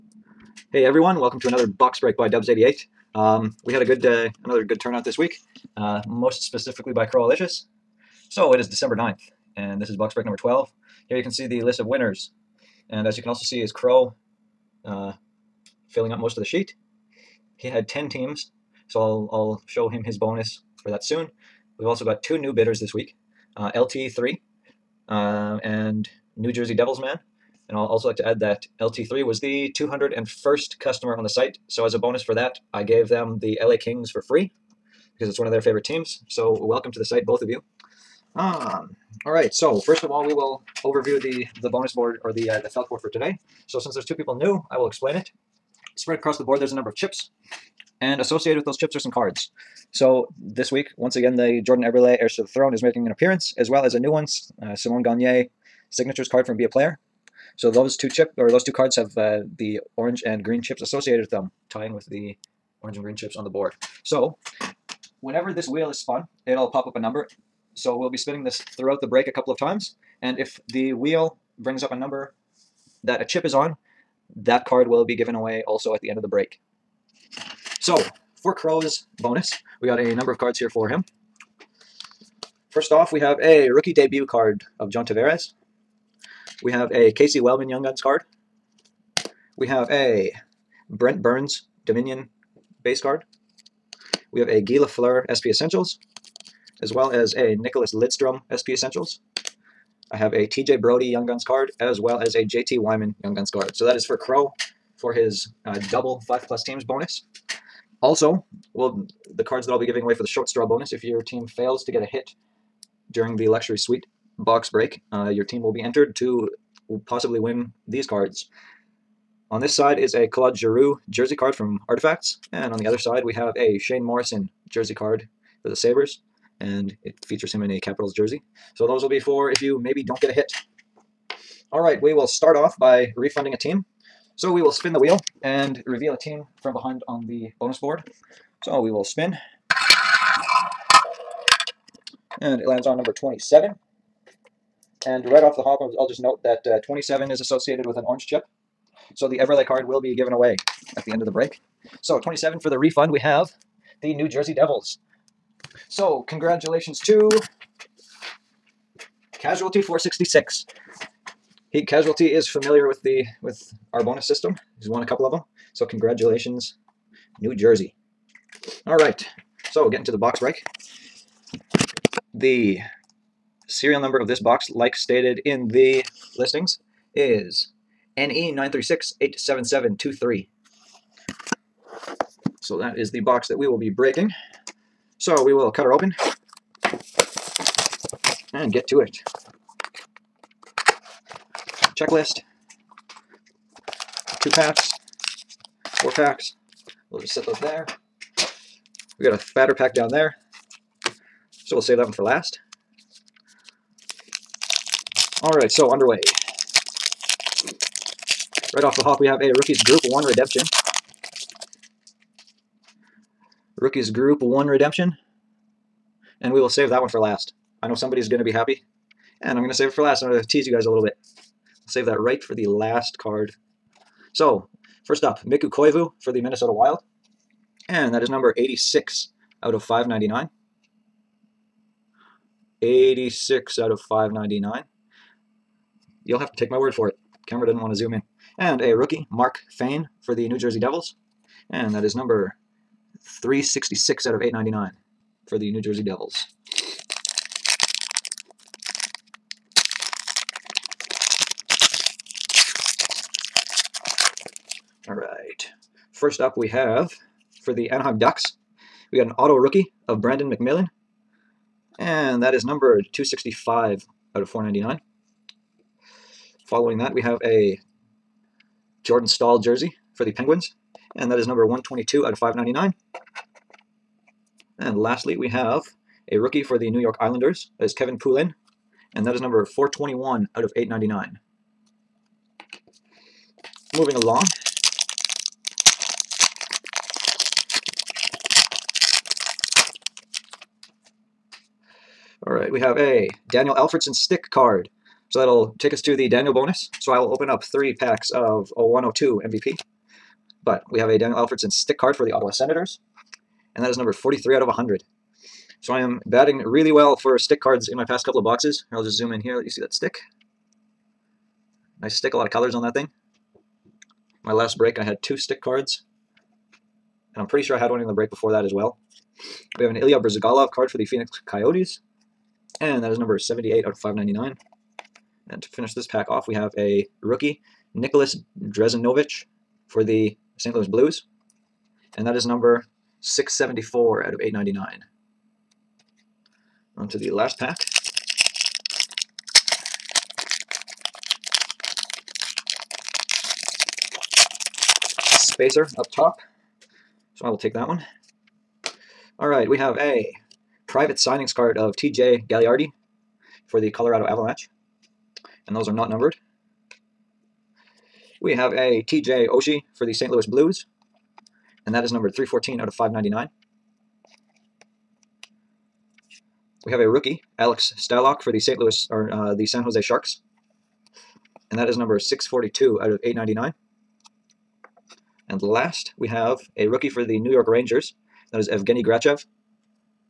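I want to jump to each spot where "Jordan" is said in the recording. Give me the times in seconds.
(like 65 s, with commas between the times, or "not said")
51 s, 269 s.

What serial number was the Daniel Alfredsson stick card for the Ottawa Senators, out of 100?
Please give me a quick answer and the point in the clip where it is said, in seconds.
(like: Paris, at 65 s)
43, at 304 s.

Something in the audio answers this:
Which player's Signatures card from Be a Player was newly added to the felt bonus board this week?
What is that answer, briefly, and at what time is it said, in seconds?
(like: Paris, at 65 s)
Simon Gagne, at 54 s.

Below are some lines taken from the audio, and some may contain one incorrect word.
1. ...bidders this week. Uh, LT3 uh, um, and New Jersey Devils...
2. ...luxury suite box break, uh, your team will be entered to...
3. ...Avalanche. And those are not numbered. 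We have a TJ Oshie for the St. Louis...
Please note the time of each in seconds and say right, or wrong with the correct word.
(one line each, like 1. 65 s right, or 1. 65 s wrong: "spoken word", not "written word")
1. 22 s right
2. 113 s right
3. 354 s right.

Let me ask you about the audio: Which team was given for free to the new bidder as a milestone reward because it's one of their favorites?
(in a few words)
LA Kings.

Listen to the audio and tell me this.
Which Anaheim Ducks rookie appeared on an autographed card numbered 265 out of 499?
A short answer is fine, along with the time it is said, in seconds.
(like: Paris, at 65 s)
Brandon McMillan, at 260 s.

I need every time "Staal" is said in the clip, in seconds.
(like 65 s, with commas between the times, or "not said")
269 s.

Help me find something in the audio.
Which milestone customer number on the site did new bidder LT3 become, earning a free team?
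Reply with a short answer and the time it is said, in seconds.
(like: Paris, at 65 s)
201st, at 29 s.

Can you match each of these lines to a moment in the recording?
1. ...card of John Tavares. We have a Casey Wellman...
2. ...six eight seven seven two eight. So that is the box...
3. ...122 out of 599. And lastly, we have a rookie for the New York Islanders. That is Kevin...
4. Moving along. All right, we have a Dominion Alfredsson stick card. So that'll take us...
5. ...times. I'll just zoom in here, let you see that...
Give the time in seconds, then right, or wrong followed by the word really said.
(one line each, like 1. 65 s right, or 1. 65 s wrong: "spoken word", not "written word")
1. 84 s right
2. 178 s wrong: "three", not "eight"
3. 271 s right
4. 283 s wrong: "Daniel", not "Dominion"
5. 308 s wrong: "boxes", not "times".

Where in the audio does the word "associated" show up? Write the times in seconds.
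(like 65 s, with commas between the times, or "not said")
48 s, 60 s, 147 s.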